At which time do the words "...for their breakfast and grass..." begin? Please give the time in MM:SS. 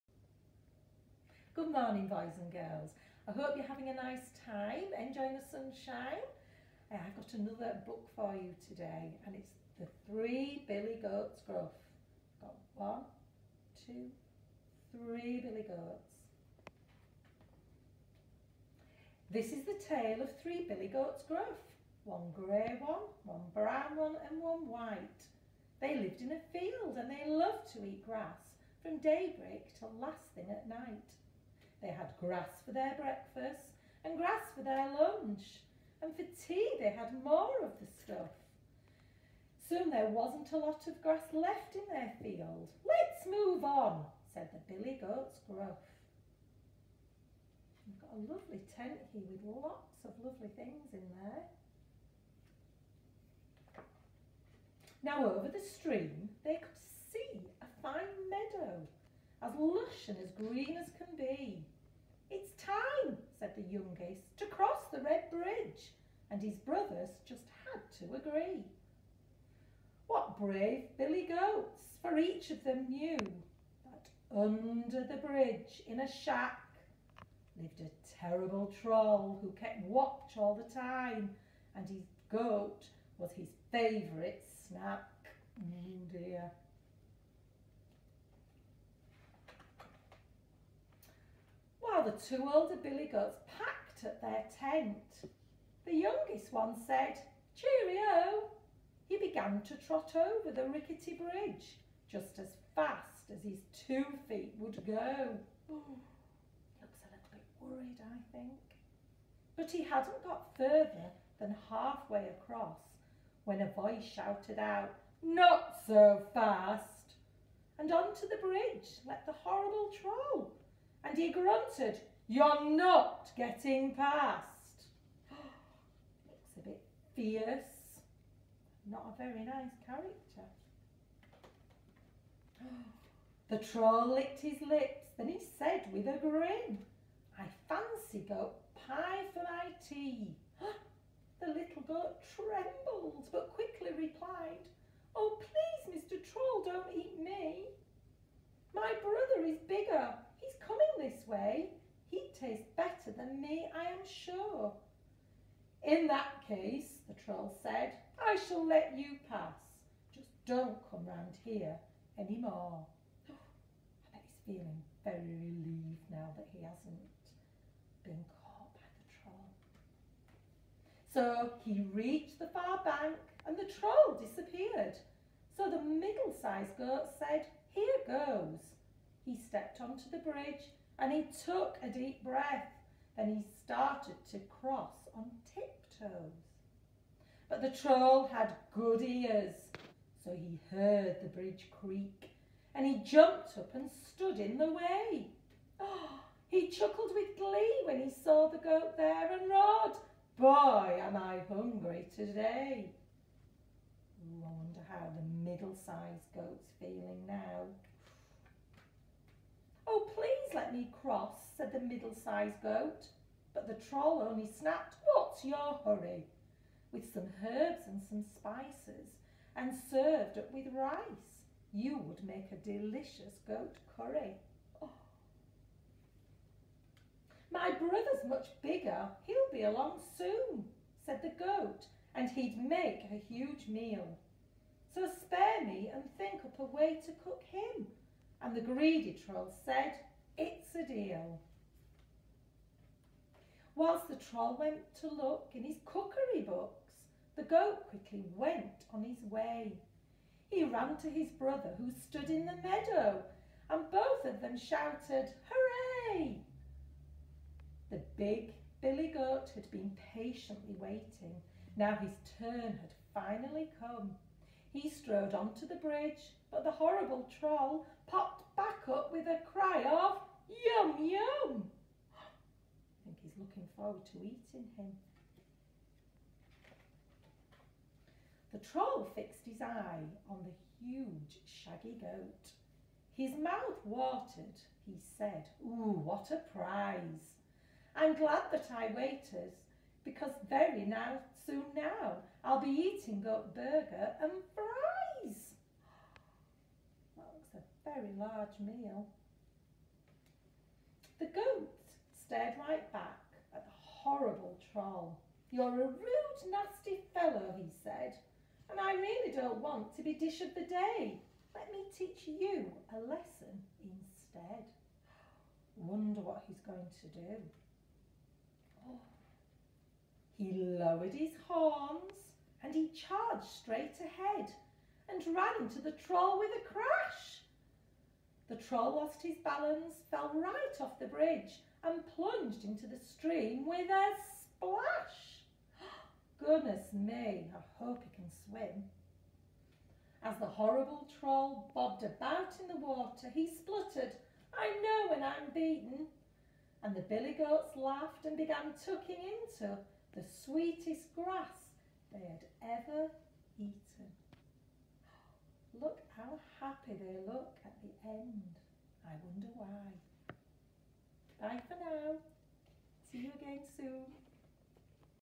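00:32.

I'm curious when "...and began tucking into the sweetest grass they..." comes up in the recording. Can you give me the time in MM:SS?
05:48.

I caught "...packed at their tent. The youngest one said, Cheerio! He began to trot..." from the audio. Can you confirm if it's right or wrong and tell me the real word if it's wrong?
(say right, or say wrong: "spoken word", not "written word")
right.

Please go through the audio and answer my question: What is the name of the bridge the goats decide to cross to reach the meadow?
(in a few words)
Red Bridge.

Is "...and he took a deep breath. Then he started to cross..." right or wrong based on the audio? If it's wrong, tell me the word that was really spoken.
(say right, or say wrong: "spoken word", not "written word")
right.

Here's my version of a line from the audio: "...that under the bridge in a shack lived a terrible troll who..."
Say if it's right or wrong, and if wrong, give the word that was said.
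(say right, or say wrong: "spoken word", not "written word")
right.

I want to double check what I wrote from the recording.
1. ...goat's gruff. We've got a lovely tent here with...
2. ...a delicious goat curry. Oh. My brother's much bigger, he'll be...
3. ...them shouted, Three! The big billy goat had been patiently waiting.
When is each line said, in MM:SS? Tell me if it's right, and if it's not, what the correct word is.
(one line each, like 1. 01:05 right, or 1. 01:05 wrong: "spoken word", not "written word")
1. 00:44 right
2. 03:42 right
3. 04:14 wrong: "Hooray", not "Three".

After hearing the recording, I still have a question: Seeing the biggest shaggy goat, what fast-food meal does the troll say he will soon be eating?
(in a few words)
burger and fries.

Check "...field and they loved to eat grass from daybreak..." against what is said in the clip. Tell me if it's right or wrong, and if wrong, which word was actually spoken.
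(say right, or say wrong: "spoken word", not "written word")
right.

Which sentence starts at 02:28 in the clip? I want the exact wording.
My brother is bigger this way, he'd taste better than me, I am sure.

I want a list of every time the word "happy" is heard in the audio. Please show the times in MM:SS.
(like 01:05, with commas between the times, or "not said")
05:56.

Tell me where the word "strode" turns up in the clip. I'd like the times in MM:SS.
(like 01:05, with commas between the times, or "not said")
04:24.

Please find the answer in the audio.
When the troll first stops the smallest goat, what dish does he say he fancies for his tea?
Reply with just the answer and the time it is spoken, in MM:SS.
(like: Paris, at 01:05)
goat pie, at 02:18.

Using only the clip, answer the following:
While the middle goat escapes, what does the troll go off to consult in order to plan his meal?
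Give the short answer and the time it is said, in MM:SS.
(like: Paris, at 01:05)
cookery books, at 04:05.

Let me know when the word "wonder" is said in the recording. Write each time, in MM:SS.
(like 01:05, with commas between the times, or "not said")
03:24, 05:15, 05:59.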